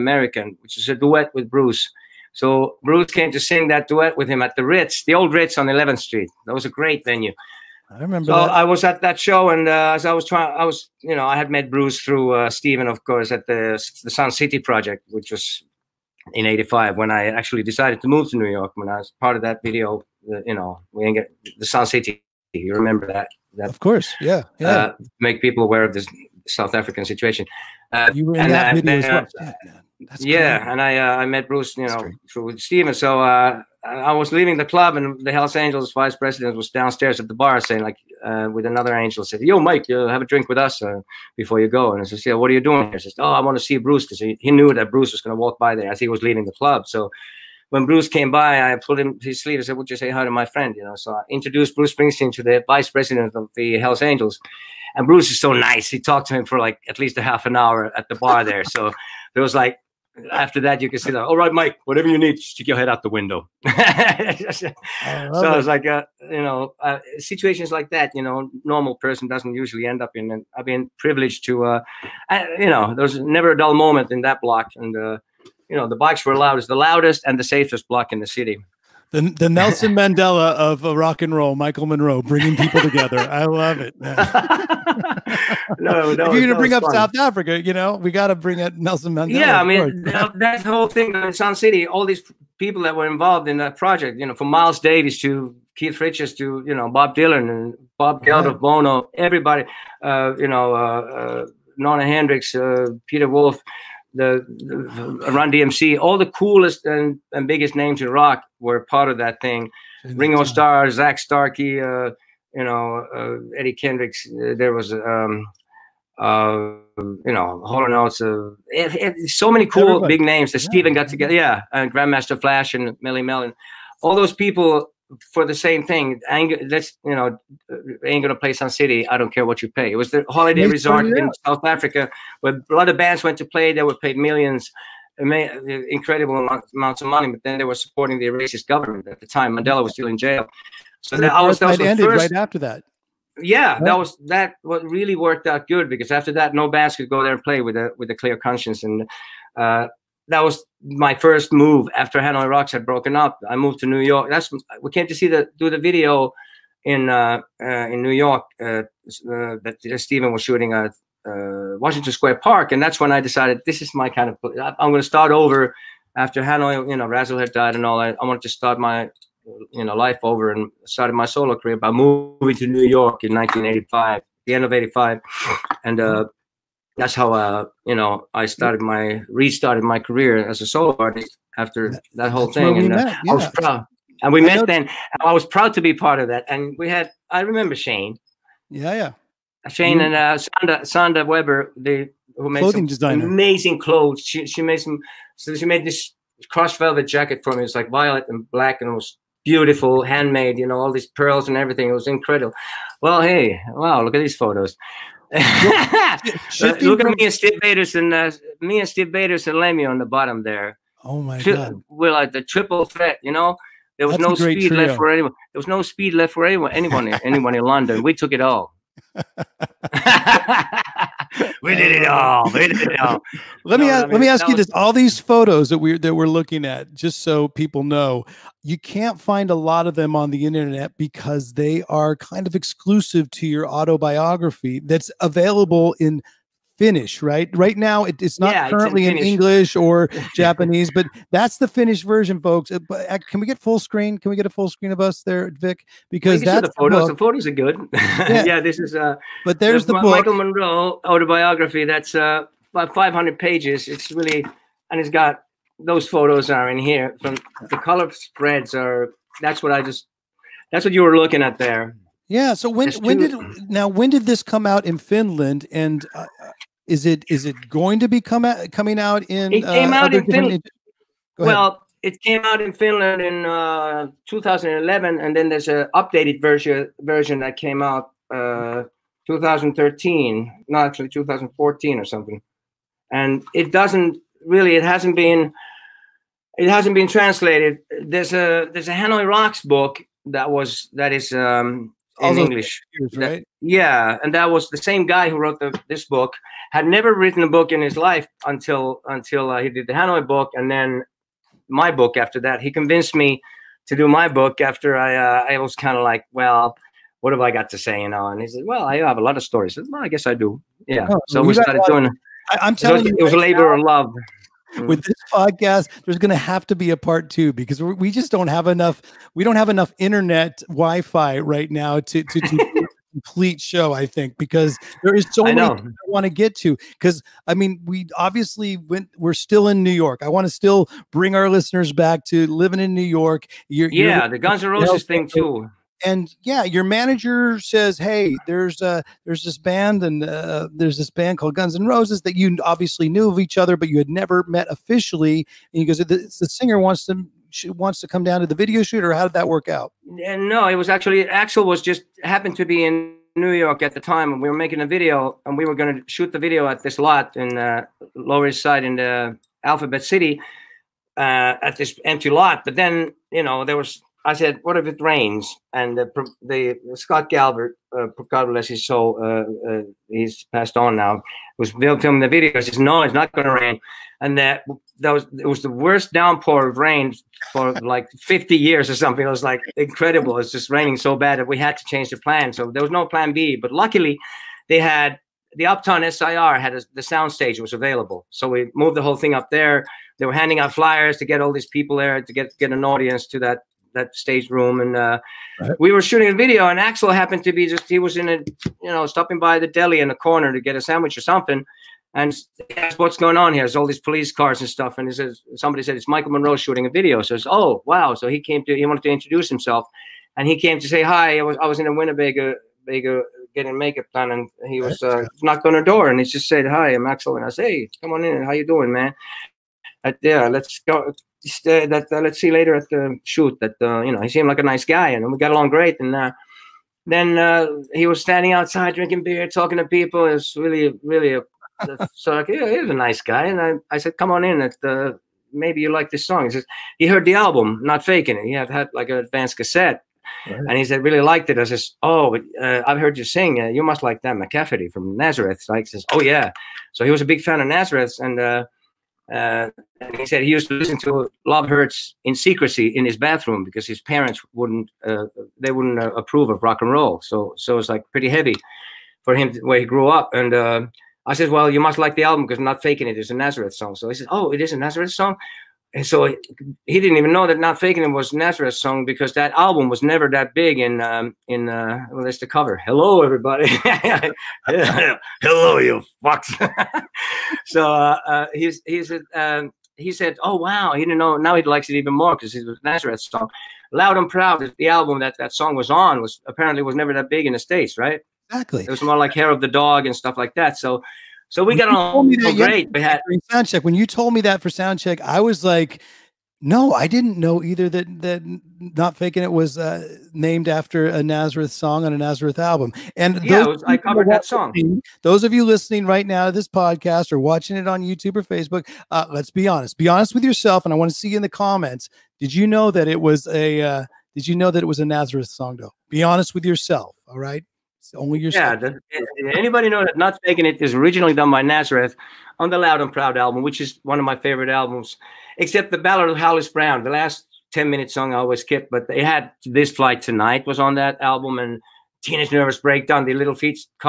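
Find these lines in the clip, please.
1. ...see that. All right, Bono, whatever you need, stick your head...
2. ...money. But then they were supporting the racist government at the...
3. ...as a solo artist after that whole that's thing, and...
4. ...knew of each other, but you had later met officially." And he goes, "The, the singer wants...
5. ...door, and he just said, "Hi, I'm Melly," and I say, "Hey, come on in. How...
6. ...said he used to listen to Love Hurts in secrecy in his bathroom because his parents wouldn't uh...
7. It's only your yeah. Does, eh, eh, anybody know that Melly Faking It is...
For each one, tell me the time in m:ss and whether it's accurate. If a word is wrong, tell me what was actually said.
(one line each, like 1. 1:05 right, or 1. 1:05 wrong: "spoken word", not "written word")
1. 1:00 wrong: "Mike", not "Bono"
2. 2:17 right
3. 3:00 right
4. 5:43 wrong: "never", not "later"
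5. 6:55 wrong: "Axl", not "Melly"
6. 7:30 right
7. 8:37 wrong: "Not", not "Melly".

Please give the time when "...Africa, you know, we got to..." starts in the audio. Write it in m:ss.
1:27.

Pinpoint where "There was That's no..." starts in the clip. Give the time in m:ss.
3:33.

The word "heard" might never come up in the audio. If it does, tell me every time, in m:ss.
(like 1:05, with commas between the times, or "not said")
7:17, 7:23.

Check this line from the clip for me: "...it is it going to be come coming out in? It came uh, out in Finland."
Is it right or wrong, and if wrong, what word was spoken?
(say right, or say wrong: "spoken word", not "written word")
right.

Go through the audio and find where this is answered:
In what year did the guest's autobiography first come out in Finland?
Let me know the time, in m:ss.
4:34.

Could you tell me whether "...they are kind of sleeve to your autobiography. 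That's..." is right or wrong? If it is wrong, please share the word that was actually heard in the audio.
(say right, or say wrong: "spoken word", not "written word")
wrong: "exclusive", not "sleeve".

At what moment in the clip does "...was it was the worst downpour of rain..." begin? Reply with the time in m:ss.
6:15.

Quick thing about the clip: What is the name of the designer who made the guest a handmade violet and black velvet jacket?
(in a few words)
Sandra Weber.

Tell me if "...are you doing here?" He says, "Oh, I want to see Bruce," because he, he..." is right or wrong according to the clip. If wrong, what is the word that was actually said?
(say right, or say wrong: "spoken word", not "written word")
right.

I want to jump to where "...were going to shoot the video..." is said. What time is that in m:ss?
5:55.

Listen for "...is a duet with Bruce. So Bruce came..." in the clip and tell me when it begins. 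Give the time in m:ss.
0:00.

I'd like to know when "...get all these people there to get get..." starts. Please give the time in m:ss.
6:31.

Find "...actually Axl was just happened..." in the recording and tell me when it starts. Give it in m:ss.
5:50.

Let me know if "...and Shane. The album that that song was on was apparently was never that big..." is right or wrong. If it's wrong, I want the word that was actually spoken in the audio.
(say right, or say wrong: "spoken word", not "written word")
wrong: "Proud", not "Shane".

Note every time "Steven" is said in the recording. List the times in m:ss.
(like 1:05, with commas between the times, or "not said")
0:12, 0:32, 2:00, 2:39.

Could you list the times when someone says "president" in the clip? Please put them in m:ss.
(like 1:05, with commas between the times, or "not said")
0:36, 0:52.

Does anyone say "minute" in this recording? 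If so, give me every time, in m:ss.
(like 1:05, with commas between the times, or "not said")
8:47.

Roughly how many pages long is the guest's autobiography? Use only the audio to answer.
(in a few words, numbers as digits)
500.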